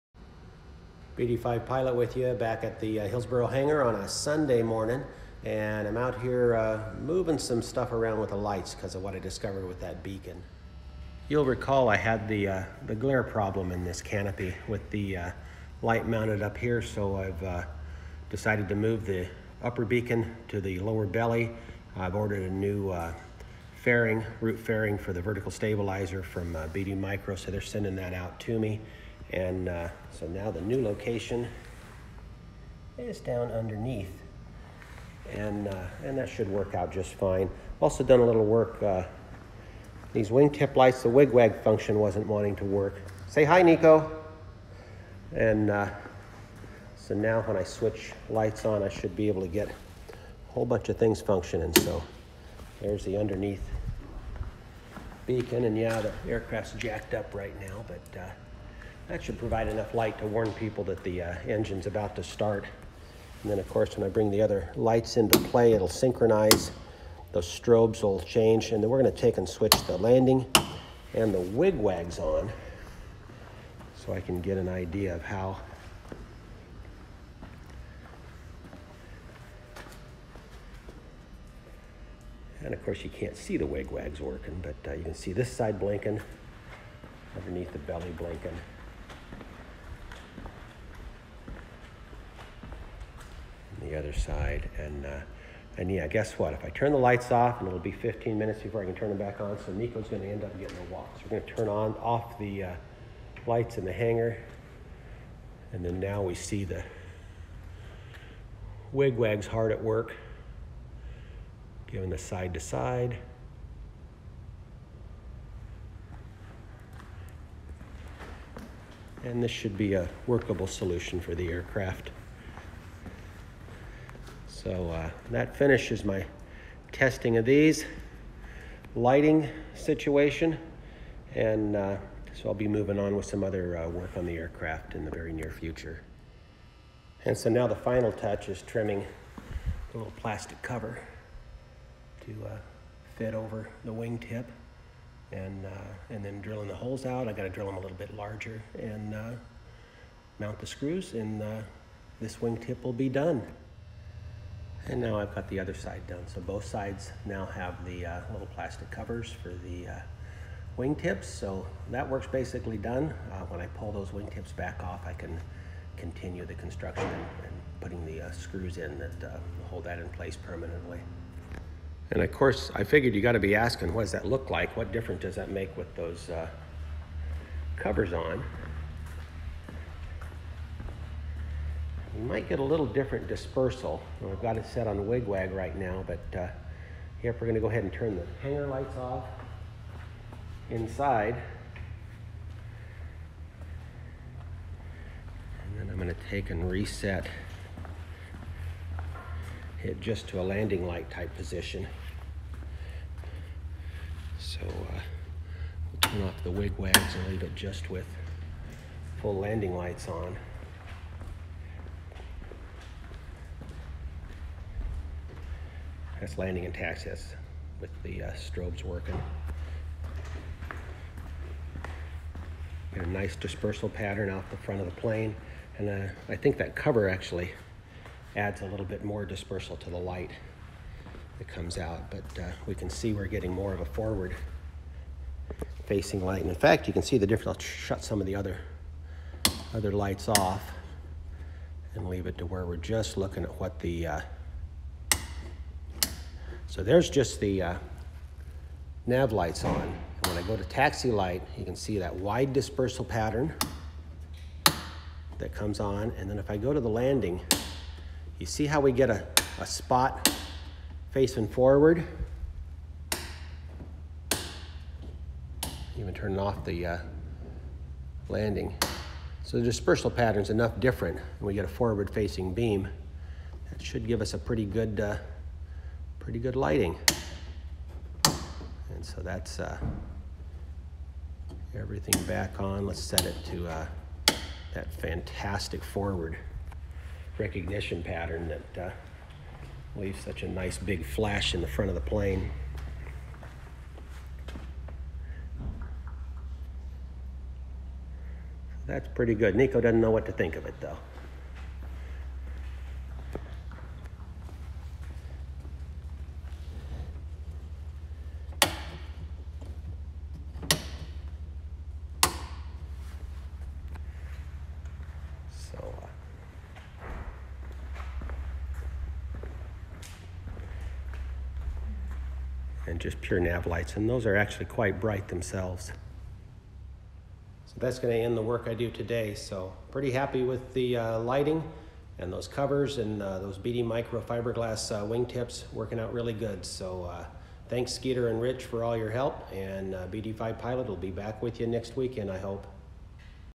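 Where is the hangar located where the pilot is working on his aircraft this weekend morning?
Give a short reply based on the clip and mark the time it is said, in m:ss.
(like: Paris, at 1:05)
Hillsboro, at 0:03.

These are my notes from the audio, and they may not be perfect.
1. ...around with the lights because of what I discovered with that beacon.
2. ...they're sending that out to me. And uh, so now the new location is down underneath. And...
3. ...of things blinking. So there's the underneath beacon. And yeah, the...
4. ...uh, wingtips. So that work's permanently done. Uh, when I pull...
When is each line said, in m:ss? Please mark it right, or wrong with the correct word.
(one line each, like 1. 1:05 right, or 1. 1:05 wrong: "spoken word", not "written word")
1. 0:07 right
2. 0:27 right
3. 0:50 wrong: "functioning", not "blinking"
4. 2:39 wrong: "basically", not "permanently".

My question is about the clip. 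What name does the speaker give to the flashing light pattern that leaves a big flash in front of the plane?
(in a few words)
forward recognition pattern.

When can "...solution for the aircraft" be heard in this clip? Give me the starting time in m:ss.
2:00.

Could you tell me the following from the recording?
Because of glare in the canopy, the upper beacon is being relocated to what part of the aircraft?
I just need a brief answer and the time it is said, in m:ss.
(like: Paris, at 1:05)
lower belly, at 0:20.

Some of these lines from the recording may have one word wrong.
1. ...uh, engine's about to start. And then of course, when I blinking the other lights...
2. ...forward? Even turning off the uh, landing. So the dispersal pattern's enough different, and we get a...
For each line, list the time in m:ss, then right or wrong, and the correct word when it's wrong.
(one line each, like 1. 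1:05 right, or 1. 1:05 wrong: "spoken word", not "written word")
1. 1:01 wrong: "bring", not "blinking"
2. 4:21 right.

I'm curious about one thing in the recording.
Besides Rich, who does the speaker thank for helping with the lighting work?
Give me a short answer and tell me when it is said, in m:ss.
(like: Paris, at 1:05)
Skeeter, at 5:37.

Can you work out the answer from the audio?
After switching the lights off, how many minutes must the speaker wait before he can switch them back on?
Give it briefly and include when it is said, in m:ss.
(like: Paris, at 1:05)
15, at 1:37.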